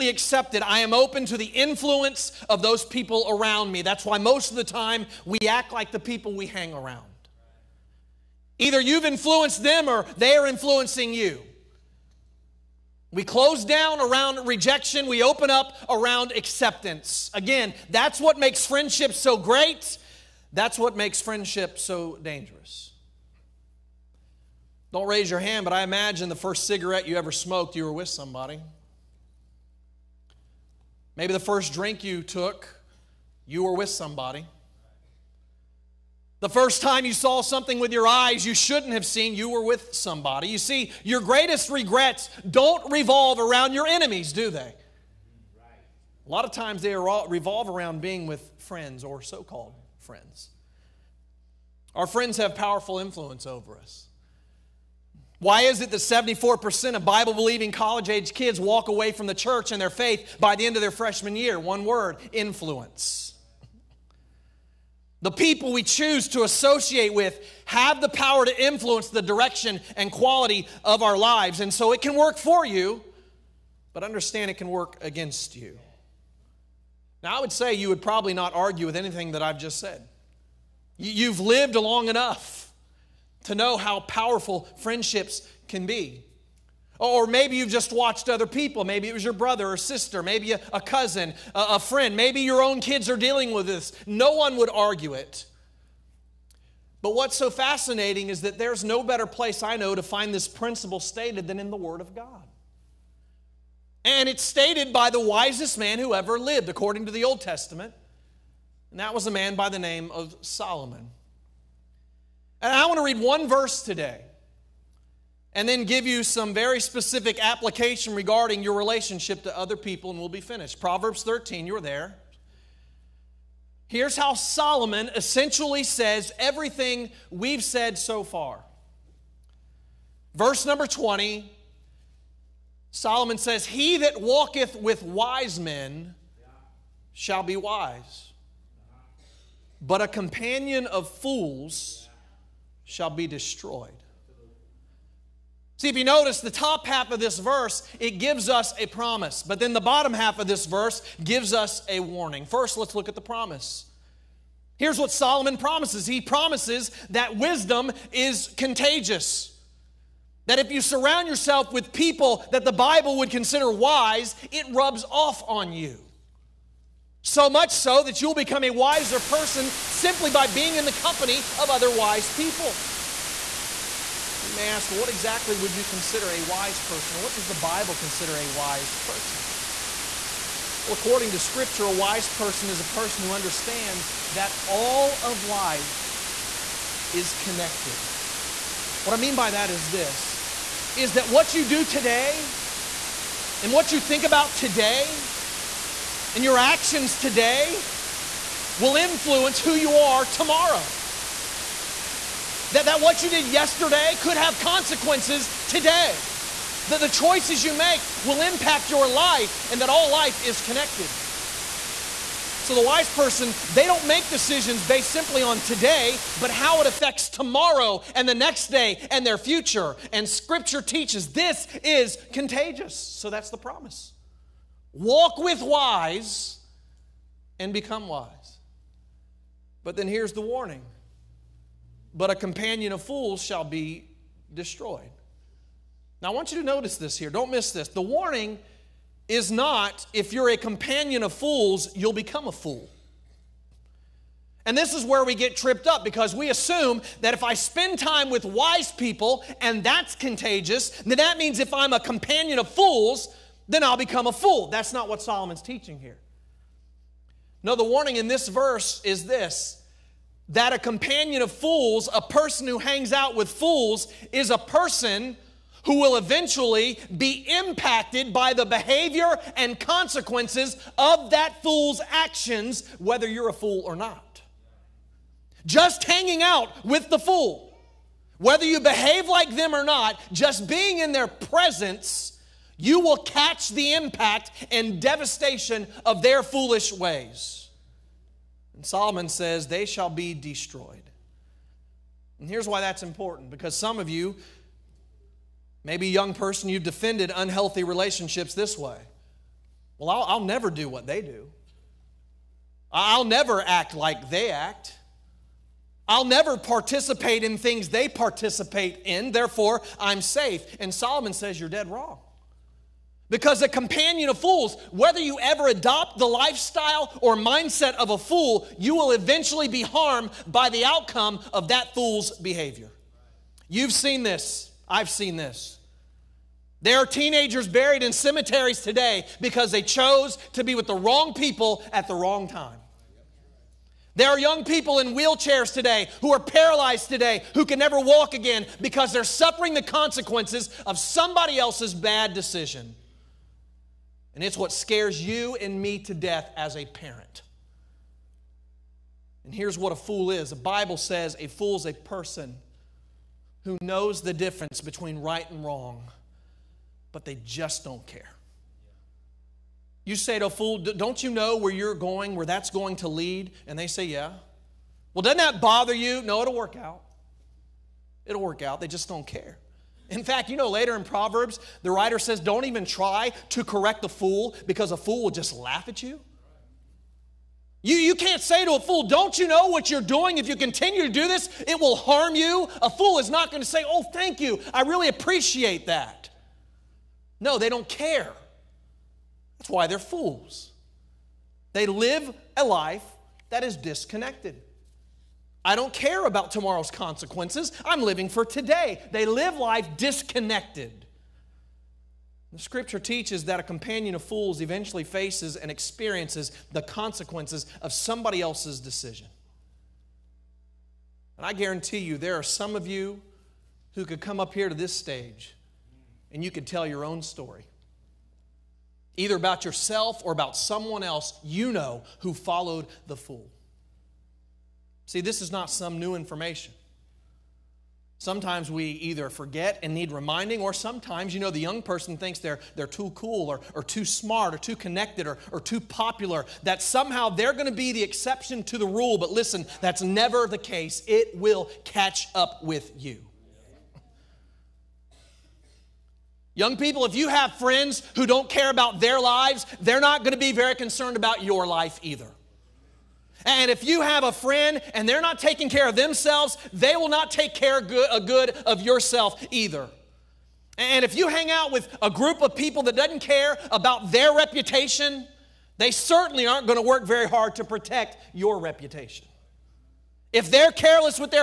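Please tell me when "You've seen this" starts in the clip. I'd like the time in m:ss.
5:23.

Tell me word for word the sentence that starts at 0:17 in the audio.
Again, that's what makes friendship so great.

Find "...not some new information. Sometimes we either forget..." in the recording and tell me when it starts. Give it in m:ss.
7:05.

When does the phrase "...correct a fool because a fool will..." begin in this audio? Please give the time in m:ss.
6:13.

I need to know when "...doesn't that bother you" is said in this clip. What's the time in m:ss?
6:05.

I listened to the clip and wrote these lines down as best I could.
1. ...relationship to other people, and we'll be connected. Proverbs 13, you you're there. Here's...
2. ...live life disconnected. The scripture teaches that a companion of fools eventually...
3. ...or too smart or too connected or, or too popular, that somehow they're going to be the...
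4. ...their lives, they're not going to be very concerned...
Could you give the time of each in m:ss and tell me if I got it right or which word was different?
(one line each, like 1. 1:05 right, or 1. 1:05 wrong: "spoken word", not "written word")
1. 1:58 wrong: "finished", not "connected"
2. 6:39 right
3. 7:13 right
4. 7:29 right.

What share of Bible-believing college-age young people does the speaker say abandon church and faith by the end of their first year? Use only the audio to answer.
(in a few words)
74%.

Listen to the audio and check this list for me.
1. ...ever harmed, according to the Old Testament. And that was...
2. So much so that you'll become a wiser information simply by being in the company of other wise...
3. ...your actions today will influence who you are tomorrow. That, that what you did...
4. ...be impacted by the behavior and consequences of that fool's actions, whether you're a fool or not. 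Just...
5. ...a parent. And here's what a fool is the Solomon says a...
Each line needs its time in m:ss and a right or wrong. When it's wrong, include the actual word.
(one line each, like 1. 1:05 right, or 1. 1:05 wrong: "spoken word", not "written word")
1. 1:46 wrong: "lived", not "harmed"
2. 2:47 wrong: "person", not "information"
3. 3:16 right
4. 4:27 right
5. 5:46 wrong: "Bible", not "Solomon".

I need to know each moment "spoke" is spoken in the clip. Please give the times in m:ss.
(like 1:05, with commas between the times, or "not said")
not said.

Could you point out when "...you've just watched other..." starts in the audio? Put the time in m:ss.
1:27.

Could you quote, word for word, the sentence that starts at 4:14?
That's not what Solomon's teaching here.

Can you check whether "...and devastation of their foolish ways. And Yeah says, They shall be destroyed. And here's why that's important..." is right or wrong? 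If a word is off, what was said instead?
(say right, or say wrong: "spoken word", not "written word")
wrong: "Solomon", not "Yeah".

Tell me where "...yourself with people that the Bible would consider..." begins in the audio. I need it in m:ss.
2:41.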